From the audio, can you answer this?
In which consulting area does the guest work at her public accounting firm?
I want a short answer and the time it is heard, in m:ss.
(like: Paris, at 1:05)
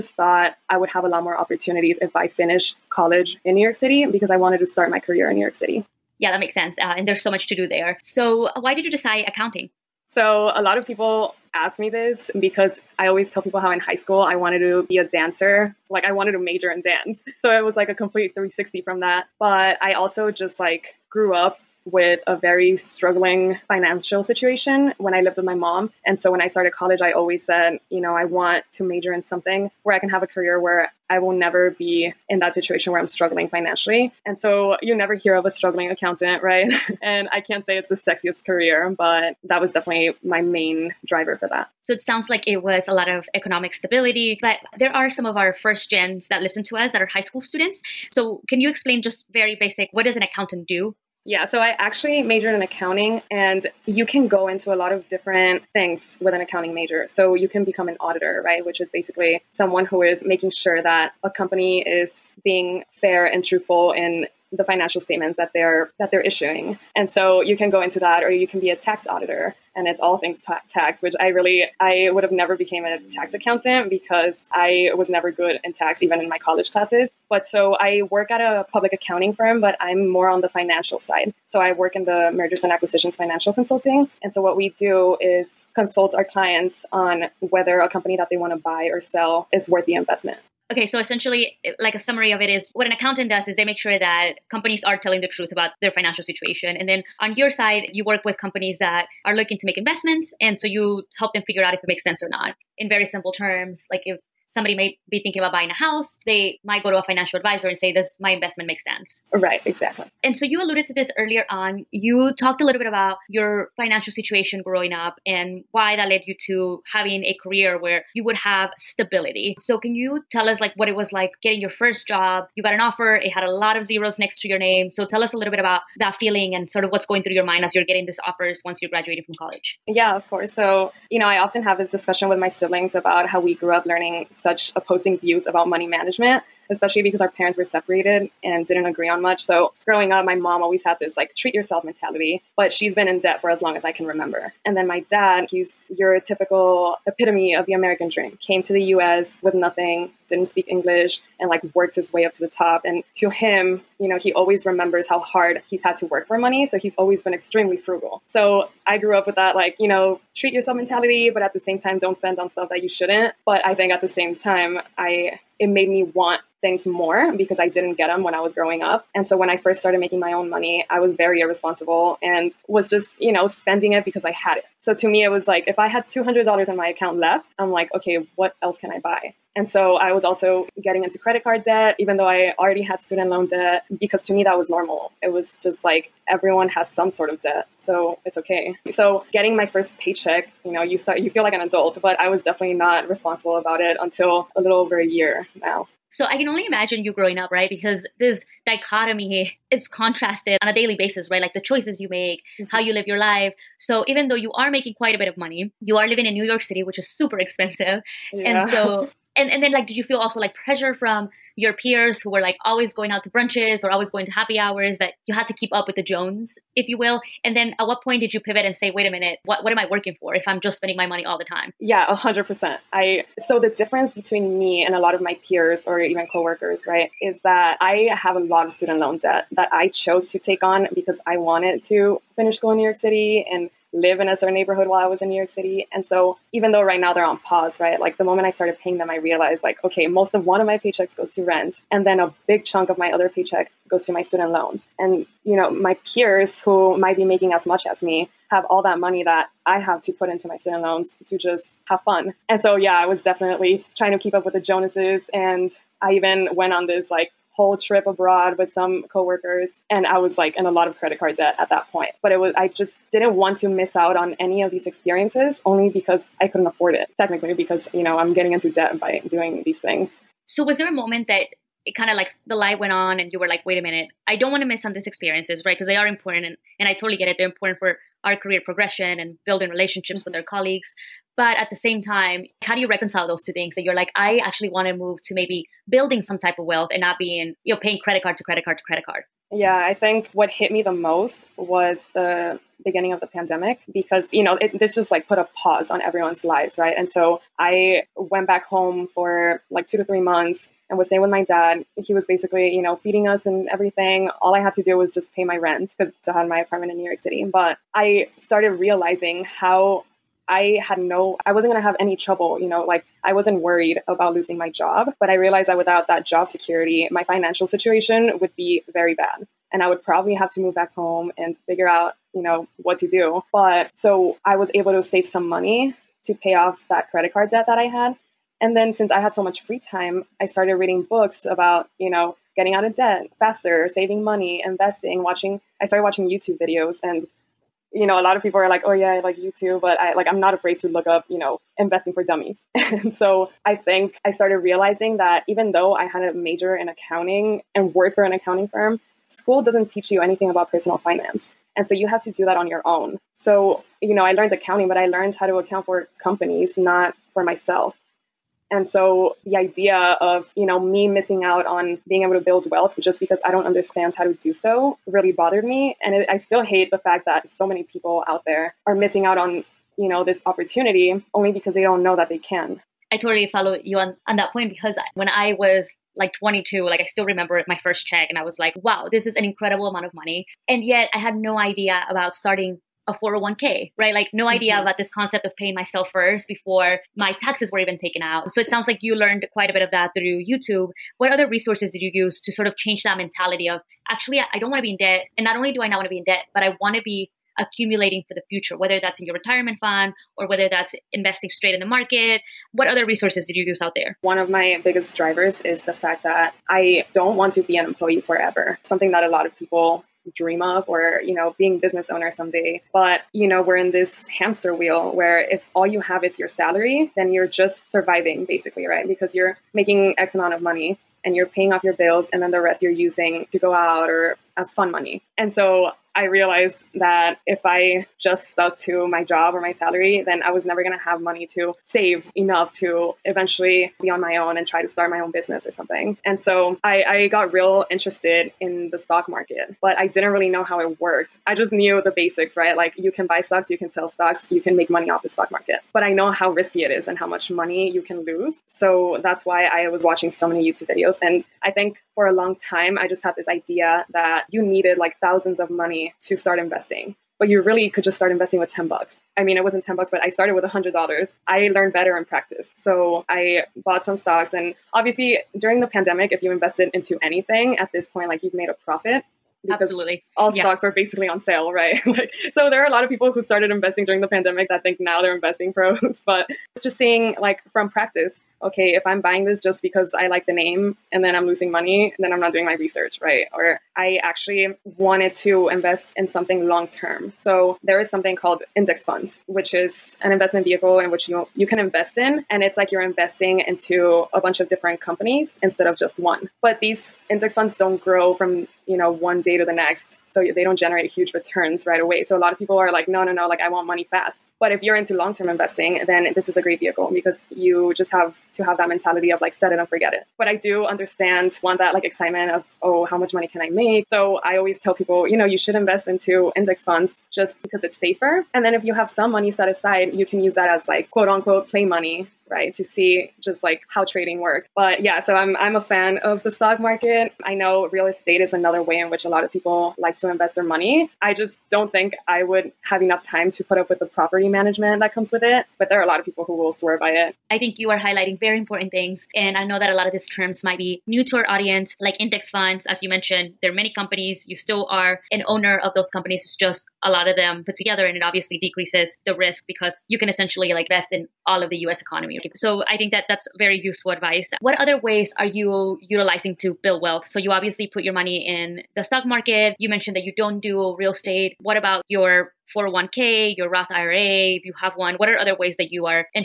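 mergers and acquisitions, at 1:22.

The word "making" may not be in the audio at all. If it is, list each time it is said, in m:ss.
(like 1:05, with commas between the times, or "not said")
1:00, 2:49, 3:24, 4:07, 6:59.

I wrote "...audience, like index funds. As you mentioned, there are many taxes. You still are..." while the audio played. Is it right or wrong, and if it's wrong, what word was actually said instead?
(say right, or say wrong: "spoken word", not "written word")
wrong: "companies", not "taxes".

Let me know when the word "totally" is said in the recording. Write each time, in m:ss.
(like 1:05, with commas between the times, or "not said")
4:36, 6:13.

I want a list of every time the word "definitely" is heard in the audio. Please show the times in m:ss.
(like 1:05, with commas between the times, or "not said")
0:39, 3:12, 4:13.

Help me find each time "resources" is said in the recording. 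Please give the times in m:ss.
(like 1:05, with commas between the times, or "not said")
6:31, 6:43.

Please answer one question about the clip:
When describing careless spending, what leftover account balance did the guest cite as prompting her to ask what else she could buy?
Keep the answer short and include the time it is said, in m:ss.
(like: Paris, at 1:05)
$200, at 2:56.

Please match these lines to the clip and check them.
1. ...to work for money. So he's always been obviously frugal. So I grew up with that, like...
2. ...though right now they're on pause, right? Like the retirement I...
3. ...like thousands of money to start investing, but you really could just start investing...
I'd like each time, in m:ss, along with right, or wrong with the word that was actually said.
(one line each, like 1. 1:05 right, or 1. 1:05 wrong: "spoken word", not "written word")
1. 2:35 wrong: "extremely", not "obviously"
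2. 3:56 wrong: "moment", not "retirement"
3. 7:34 right.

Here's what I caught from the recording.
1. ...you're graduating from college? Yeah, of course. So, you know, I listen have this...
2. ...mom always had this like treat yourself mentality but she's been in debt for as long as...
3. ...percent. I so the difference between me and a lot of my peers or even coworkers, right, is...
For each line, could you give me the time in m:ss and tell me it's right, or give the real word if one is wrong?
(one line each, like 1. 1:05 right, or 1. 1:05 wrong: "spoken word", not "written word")
1. 2:08 wrong: "often", not "listen"
2. 2:20 right
3. 3:42 right.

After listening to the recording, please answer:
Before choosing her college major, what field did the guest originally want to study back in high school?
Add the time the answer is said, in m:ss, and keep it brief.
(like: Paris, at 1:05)
dance, at 0:16.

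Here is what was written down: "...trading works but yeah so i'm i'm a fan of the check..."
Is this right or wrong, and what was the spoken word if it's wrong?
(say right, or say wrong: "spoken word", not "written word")
wrong: "stock", not "check".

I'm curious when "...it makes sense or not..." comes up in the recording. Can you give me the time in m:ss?
1:41.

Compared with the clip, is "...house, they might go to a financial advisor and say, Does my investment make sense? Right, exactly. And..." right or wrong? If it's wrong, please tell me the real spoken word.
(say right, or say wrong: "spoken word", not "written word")
right.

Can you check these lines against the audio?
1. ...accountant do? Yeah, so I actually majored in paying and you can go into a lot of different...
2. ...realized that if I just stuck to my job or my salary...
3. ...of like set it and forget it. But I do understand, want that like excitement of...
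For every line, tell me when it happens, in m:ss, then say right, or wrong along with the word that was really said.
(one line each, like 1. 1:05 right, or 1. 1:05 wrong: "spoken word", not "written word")
1. 0:50 wrong: "accounting", not "paying"
2. 7:06 right
3. 8:29 right.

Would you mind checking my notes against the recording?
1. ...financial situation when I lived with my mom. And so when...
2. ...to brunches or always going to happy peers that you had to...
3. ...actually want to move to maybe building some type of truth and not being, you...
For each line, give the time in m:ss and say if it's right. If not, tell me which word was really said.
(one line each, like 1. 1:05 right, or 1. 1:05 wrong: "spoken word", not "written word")
1. 0:23 right
2. 3:33 wrong: "hours", not "peers"
3. 4:44 wrong: "wealth", not "truth".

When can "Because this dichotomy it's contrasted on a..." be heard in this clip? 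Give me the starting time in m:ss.
3:17.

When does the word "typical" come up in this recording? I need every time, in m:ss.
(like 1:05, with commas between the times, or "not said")
2:26.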